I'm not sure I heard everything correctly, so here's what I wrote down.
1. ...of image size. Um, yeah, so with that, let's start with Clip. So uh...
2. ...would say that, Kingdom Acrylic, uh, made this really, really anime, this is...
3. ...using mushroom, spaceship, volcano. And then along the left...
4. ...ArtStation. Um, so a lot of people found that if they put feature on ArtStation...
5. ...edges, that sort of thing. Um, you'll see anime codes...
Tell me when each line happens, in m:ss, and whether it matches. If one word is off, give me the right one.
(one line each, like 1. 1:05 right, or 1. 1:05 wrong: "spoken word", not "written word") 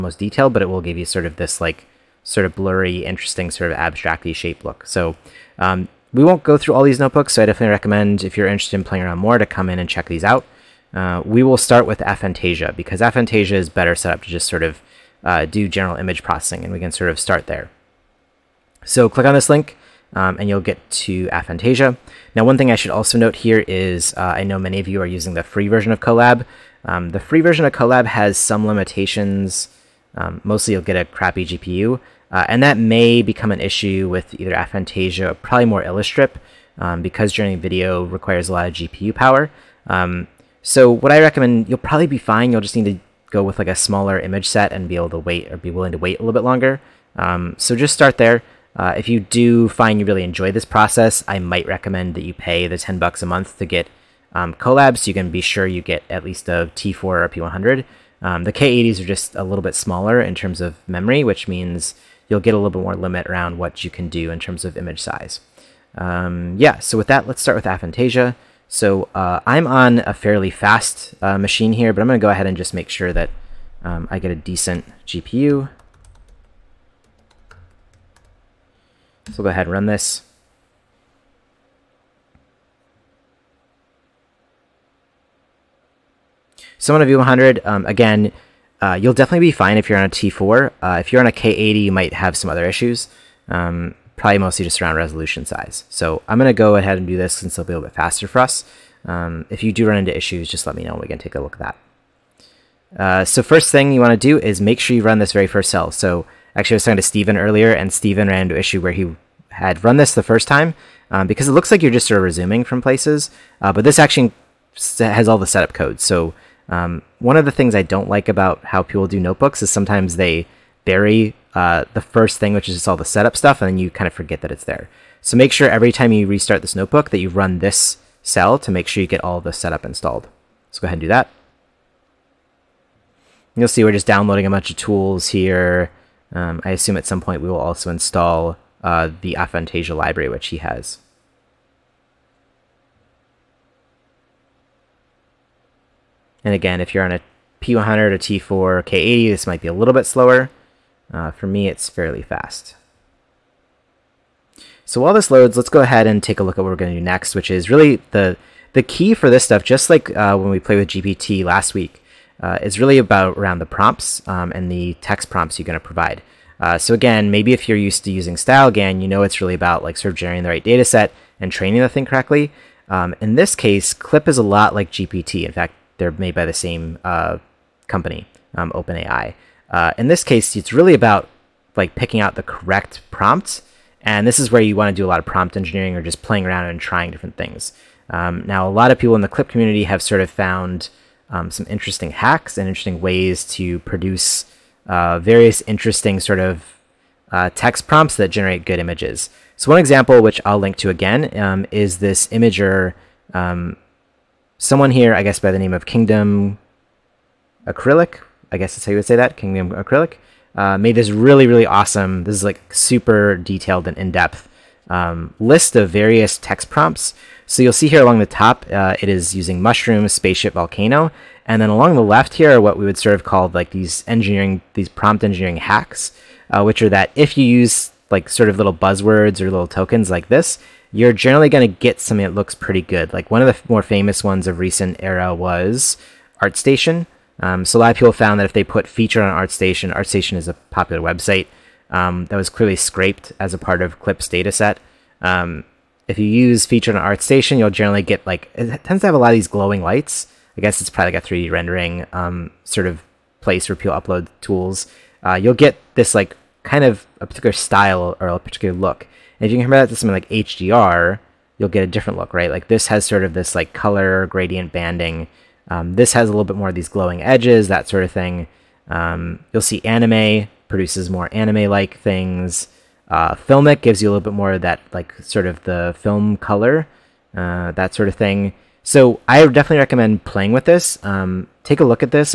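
1. 1:04 wrong: "Aphantasia", not "Clip"
2. 3:28 wrong: "awesome", not "anime"
3. 3:39 right
4. 3:56 right
5. 4:27 wrong: "produces", not "codes".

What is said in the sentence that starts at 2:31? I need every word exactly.
Uh, for me, it's fairly fast.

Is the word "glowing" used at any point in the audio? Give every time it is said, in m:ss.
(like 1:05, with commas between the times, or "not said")
4:09, 4:26.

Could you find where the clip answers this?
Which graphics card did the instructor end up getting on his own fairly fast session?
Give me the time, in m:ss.
1:27.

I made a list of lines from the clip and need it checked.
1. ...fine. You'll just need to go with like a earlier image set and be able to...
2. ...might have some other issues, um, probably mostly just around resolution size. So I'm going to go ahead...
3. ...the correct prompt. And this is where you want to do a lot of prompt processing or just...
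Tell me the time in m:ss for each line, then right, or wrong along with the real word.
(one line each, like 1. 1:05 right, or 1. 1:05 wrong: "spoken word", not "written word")
1. 0:42 wrong: "smaller", not "earlier"
2. 1:31 right
3. 3:02 wrong: "engineering", not "processing".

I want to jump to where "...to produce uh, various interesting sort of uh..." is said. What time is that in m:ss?
3:13.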